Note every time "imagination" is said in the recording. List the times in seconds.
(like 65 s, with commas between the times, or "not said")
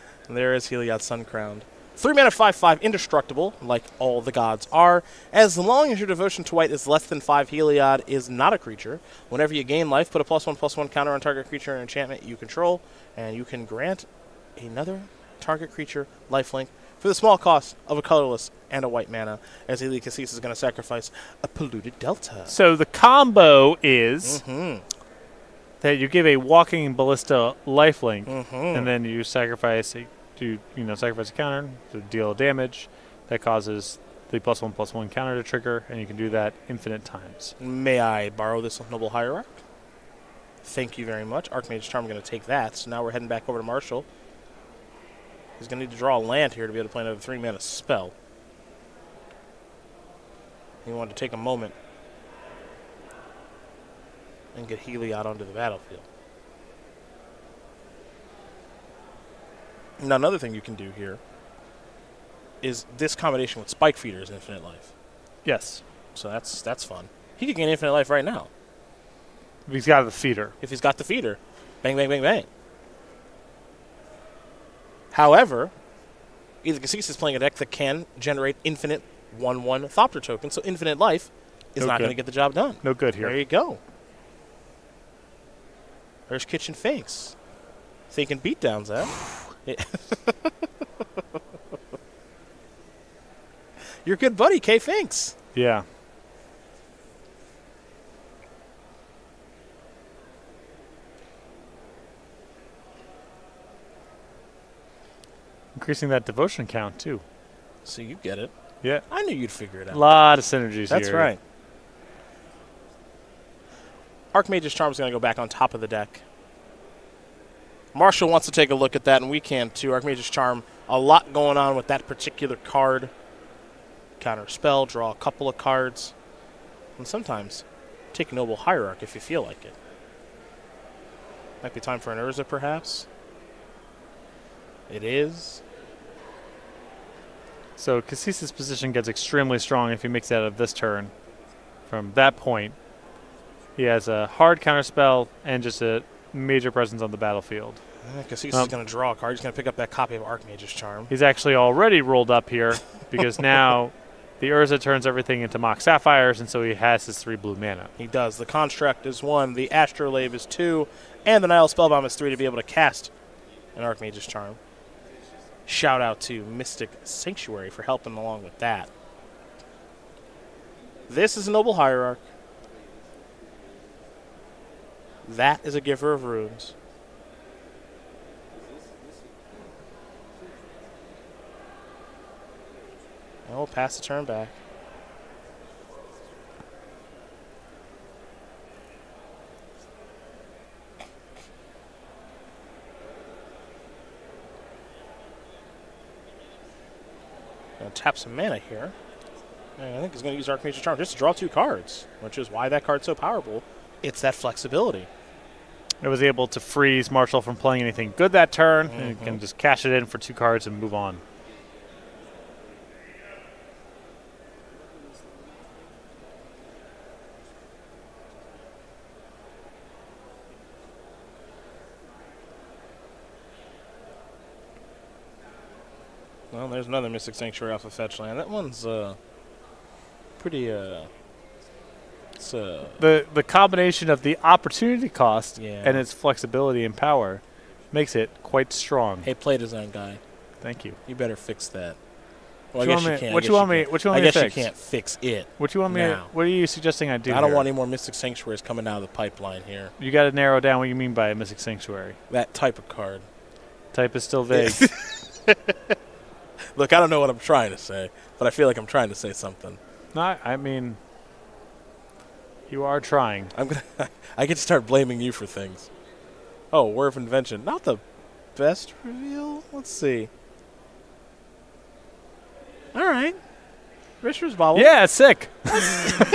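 not said.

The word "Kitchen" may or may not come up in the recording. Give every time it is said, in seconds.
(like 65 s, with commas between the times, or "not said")
86 s.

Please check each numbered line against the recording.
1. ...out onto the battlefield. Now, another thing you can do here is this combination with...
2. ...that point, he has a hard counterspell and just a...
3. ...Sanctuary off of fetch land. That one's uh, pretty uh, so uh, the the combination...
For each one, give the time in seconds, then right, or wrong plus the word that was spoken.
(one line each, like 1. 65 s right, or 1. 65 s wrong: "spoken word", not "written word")
1. 55 s right
2. 142 s right
3. 227 s right.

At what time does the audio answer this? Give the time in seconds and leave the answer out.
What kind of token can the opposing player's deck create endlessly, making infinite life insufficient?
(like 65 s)
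79 s.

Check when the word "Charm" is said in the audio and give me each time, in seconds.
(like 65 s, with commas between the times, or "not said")
41 s, 114 s, 120 s, 150 s, 164 s, 200 s.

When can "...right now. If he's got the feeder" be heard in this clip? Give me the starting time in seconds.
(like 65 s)
68 s.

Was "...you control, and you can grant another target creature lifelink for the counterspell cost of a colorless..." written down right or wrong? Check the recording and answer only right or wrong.
wrong.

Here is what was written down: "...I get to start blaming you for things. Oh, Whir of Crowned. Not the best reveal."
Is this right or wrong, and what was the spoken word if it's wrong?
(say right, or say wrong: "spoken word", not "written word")
wrong: "Invention", not "Crowned".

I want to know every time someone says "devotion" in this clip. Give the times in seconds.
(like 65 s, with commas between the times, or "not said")
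6 s, 106 s.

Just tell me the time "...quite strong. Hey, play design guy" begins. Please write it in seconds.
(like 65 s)
238 s.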